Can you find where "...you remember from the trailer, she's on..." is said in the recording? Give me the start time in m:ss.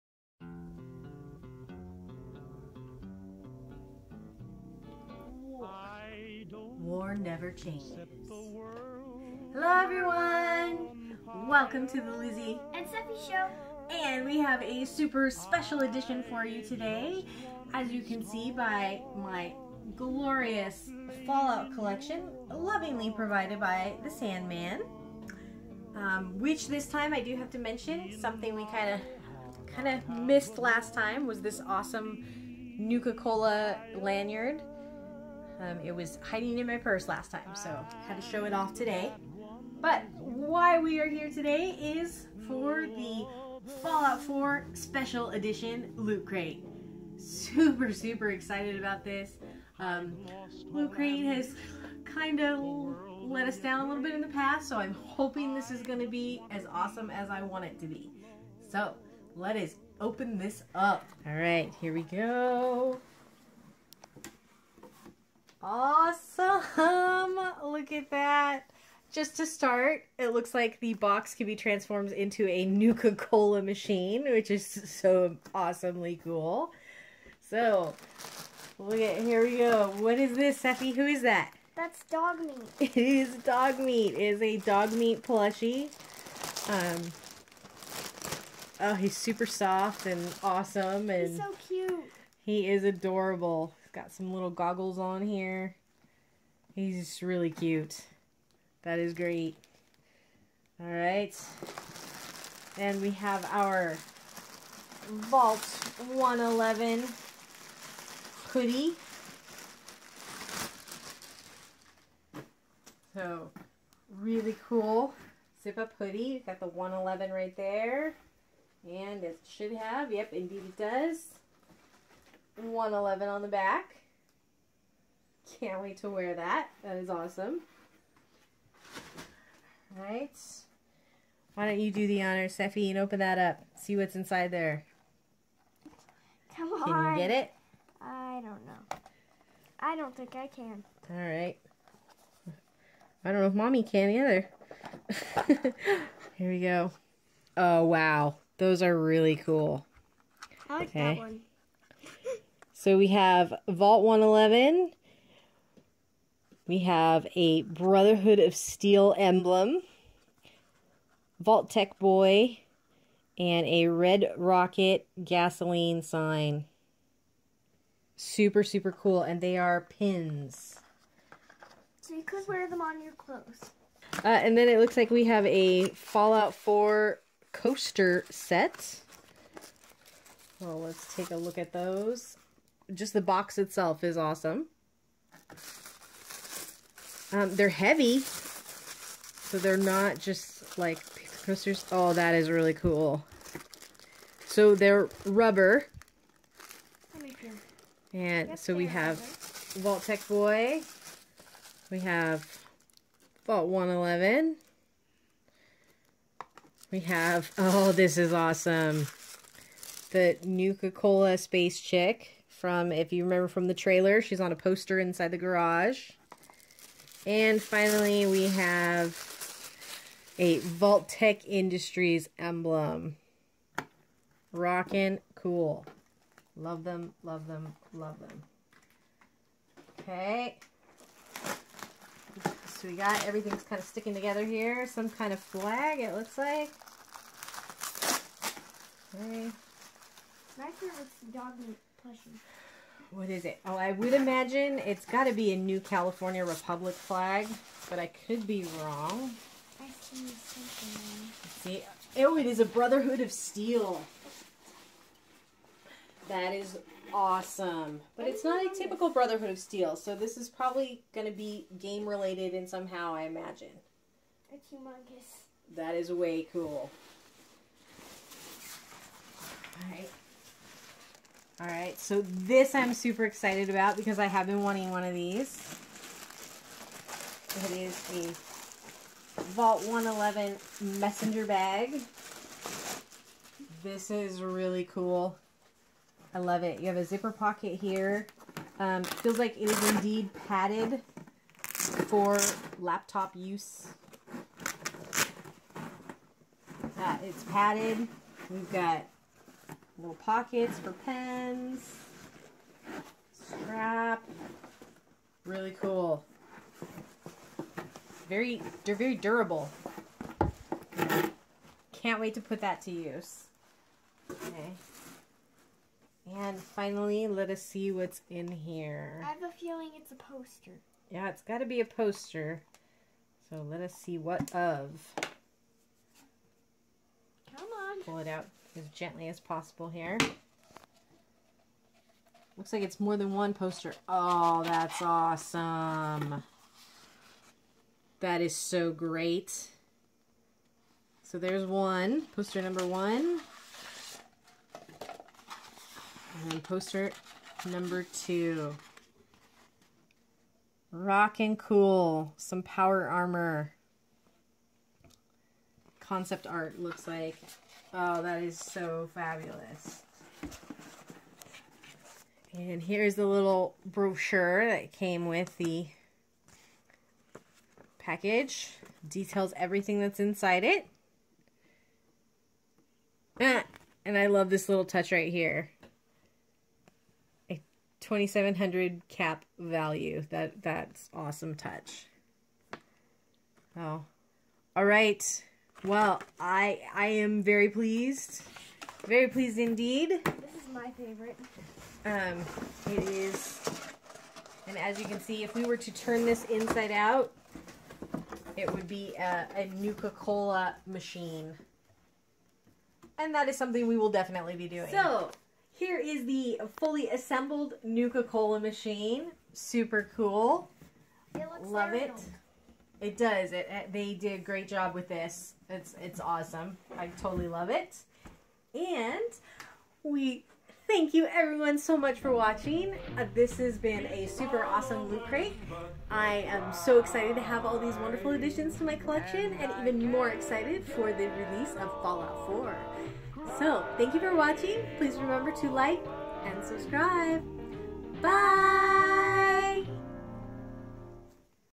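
3:33.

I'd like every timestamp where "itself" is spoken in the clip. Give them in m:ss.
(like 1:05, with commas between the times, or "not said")
3:03.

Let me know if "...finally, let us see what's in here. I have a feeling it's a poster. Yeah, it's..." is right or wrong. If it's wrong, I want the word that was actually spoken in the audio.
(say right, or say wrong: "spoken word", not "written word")
right.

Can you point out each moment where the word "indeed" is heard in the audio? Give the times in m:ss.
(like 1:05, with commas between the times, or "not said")
2:00, 4:49, 6:29.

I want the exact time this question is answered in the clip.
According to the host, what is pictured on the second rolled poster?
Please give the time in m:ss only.
5:52.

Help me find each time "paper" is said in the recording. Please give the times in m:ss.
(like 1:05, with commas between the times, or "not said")
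3:11.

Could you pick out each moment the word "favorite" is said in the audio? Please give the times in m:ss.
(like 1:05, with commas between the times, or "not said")
4:00, 6:30.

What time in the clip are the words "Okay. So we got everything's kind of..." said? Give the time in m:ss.
3:49.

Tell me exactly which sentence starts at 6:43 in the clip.
And that is something we will definitely be doing.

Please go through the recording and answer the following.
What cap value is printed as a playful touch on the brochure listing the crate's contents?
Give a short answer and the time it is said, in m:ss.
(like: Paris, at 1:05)
2700, at 6:17.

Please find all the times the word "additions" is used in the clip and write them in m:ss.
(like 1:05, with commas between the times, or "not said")
7:08.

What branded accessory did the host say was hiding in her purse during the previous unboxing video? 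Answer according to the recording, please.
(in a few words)
Nuka-Cola lanyard.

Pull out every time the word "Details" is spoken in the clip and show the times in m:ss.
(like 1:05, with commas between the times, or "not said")
6:09.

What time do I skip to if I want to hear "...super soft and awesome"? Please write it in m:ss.
1:29.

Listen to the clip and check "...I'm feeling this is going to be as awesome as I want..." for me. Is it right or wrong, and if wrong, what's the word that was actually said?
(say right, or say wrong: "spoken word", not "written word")
wrong: "hoping", not "feeling".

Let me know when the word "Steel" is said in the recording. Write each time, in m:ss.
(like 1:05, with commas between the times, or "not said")
2:38, 4:13, 4:19.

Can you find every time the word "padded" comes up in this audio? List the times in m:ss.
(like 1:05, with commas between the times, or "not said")
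4:50, 4:57.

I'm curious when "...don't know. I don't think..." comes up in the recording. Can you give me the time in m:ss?
2:18.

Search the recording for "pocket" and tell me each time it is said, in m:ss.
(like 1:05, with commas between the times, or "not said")
4:47, 5:00.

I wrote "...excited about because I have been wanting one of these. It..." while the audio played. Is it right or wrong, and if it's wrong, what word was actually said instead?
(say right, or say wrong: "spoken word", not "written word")
right.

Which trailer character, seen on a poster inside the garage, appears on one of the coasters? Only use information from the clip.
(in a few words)
The Nuka-Cola Space Chick.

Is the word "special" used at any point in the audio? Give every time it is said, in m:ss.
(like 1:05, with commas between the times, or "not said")
0:15, 0:44.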